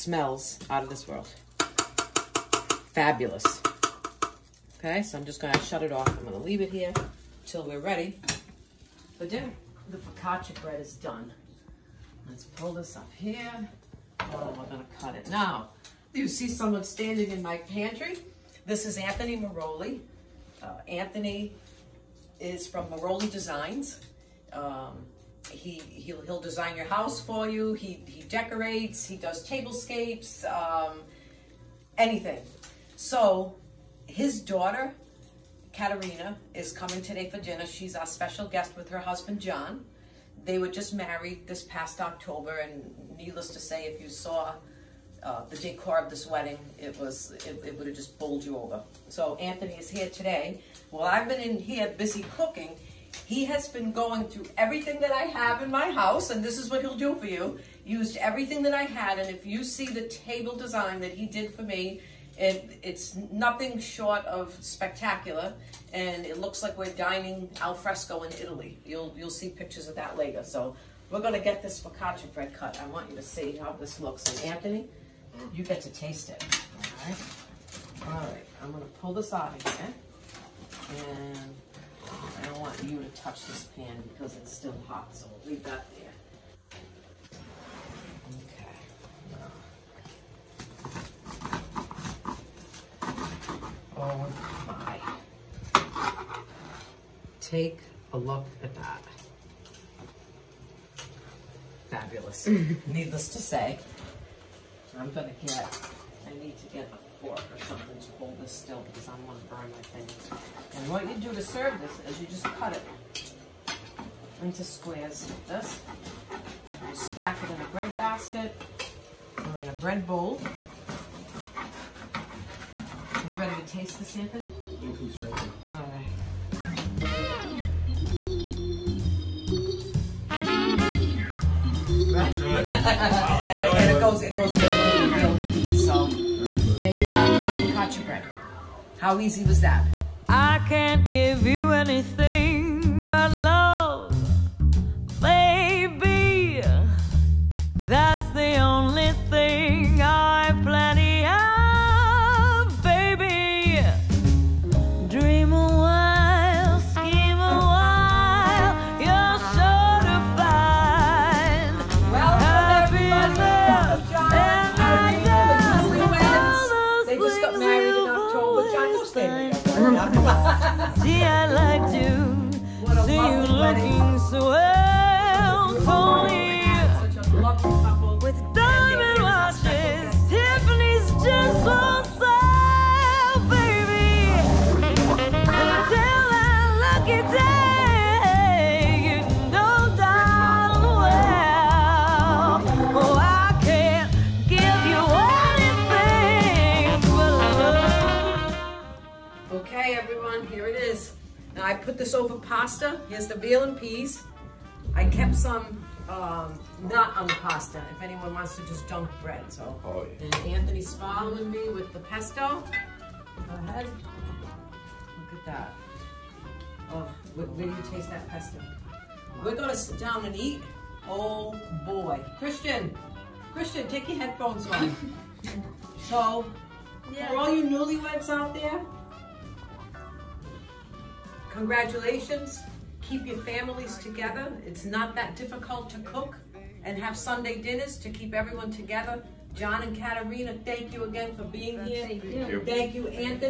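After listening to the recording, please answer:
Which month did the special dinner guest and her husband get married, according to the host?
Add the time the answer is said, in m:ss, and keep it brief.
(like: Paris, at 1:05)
October, at 0:41.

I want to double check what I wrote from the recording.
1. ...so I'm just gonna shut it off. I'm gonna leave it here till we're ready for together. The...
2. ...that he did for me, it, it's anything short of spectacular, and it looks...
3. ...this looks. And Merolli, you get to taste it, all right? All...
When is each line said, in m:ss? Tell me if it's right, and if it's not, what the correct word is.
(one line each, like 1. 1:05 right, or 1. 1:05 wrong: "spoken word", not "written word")
1. 0:05 wrong: "dinner", not "together"
2. 1:01 wrong: "nothing", not "anything"
3. 1:13 wrong: "Anthony", not "Merolli".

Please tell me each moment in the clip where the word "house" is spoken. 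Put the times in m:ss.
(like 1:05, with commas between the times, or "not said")
0:26, 0:55.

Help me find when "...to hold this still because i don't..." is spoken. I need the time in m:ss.
1:47.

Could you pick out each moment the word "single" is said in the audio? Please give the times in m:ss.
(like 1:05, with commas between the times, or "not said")
not said.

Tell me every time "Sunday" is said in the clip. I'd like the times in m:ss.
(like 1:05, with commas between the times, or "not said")
3:57.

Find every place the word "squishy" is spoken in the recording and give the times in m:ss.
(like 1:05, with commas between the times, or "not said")
not said.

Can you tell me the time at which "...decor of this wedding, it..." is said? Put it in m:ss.
0:45.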